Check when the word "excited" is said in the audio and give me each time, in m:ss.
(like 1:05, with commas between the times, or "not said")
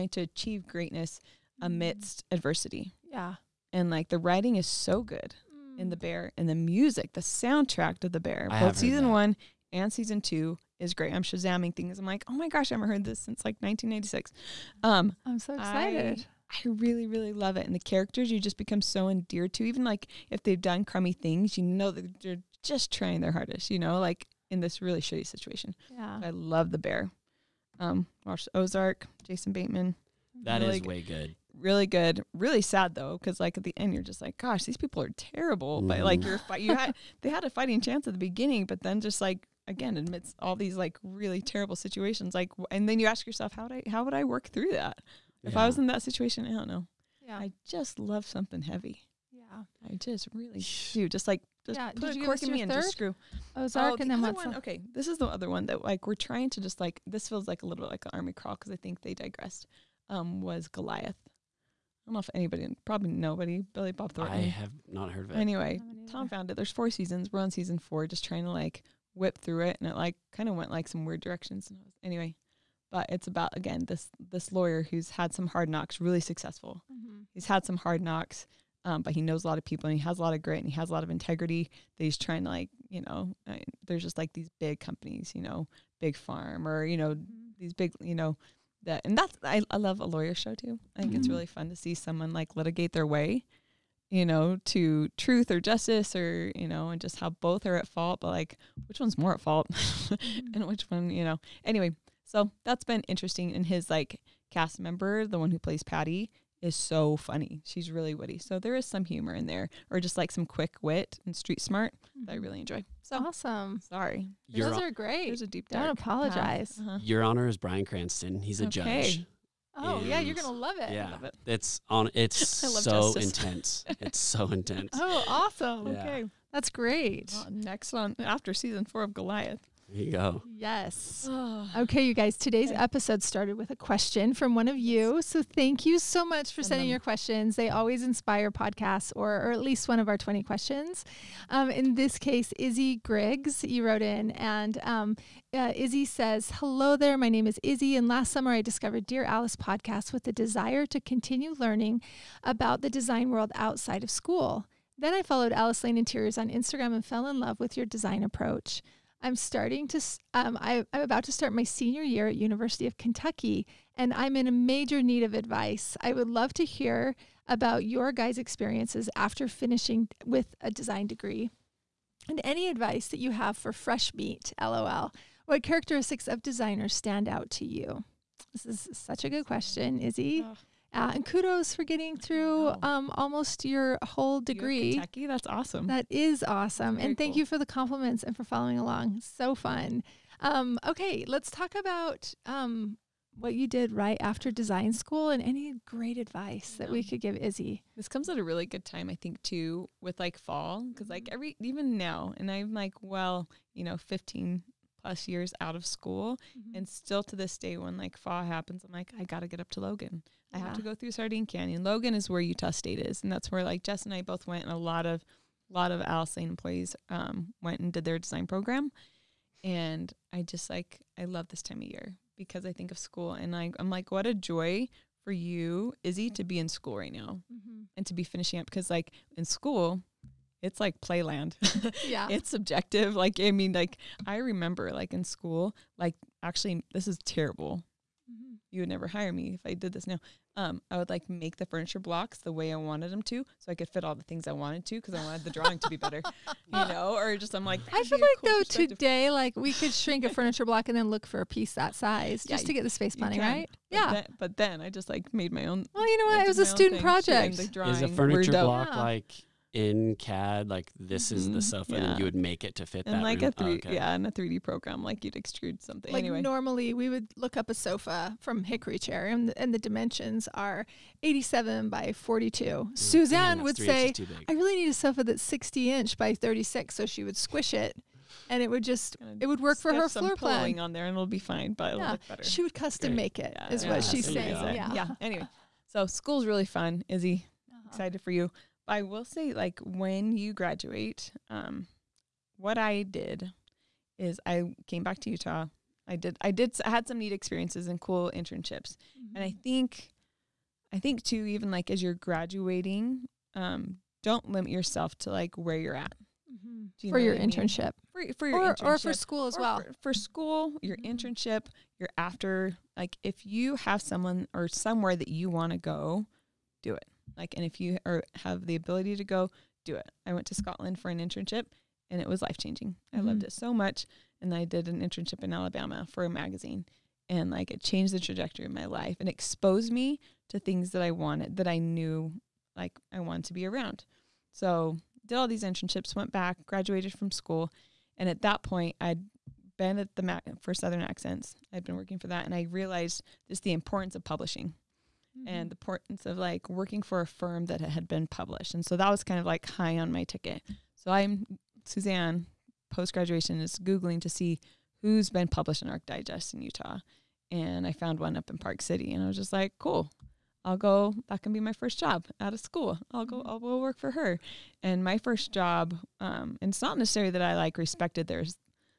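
0:15, 4:47.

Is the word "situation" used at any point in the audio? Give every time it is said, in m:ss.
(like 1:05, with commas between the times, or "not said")
0:25, 0:41, 0:46.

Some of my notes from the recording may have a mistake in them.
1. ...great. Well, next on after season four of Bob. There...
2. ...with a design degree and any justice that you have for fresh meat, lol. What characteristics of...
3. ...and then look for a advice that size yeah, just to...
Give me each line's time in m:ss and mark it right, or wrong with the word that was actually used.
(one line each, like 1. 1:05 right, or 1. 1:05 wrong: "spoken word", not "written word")
1. 2:06 wrong: "Goliath", not "Bob"
2. 2:50 wrong: "advice", not "justice"
3. 4:10 wrong: "piece", not "advice".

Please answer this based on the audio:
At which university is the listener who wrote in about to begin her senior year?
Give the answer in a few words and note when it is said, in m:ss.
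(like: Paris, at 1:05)
University of Kentucky, at 2:42.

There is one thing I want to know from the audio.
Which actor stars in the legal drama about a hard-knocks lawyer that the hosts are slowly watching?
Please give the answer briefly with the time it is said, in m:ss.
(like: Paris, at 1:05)
Billy Bob Thornton, at 1:03.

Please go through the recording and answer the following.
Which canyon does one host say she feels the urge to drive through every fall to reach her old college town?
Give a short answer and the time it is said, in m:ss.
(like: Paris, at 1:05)
Sardine Canyon, at 3:31.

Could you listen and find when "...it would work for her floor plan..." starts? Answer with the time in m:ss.
4:39.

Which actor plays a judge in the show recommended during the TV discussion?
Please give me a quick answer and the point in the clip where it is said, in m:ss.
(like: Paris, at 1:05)
Bryan Cranston, at 1:57.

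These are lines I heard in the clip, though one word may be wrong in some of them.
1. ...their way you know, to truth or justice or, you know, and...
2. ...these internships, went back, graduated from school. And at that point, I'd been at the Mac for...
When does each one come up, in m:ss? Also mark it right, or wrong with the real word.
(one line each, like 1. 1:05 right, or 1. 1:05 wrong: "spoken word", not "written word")
1. 1:32 right
2. 5:35 right.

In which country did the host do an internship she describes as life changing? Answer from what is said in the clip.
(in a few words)
Scotland.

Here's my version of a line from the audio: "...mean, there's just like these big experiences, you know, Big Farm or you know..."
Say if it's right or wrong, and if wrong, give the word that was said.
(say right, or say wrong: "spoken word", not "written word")
wrong: "companies", not "experiences".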